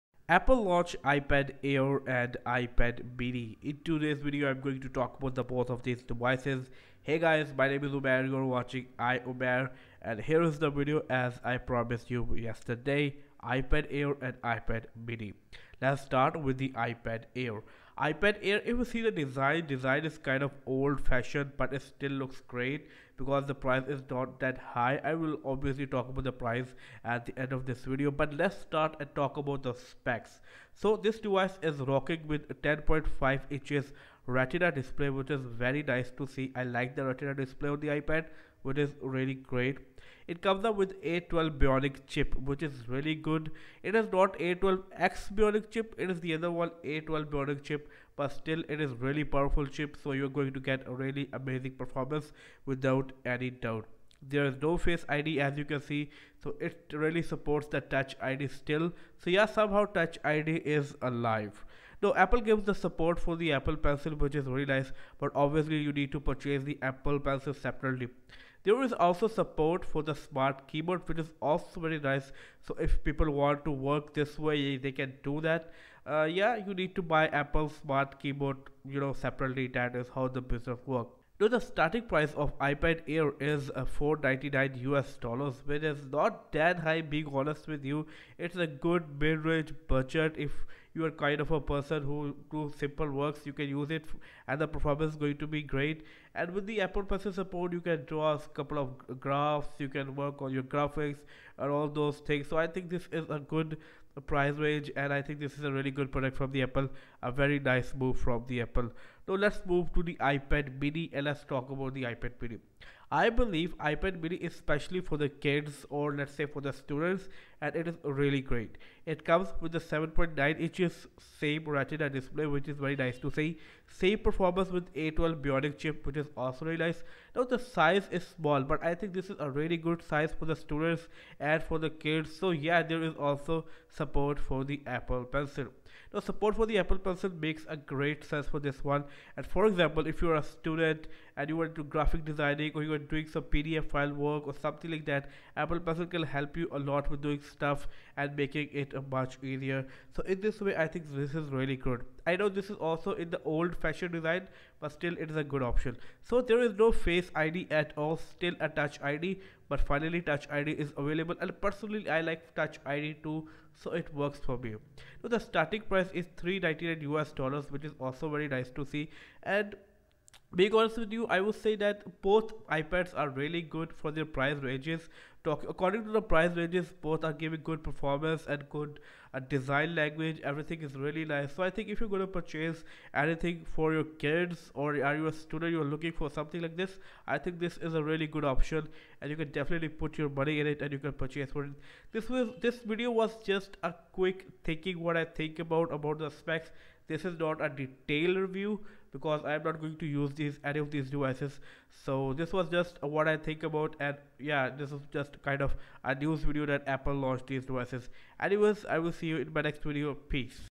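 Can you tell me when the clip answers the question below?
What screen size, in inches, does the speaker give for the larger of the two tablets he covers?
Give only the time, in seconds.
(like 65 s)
32 s.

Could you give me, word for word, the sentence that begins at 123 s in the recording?
Same performance with A12 Bionic chip which is also really nice.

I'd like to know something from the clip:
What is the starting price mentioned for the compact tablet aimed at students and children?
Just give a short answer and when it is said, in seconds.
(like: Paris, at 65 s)
$399, at 166 s.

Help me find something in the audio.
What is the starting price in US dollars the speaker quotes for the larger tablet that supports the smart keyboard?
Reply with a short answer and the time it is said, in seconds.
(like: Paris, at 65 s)
$499, at 83 s.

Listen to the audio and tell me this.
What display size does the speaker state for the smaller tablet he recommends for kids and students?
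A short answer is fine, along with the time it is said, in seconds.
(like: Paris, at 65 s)
7.9 inches, at 119 s.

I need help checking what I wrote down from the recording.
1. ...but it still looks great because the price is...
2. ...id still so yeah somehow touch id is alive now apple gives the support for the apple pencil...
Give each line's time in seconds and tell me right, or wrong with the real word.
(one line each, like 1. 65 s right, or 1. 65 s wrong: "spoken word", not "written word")
1. 21 s right
2. 58 s right.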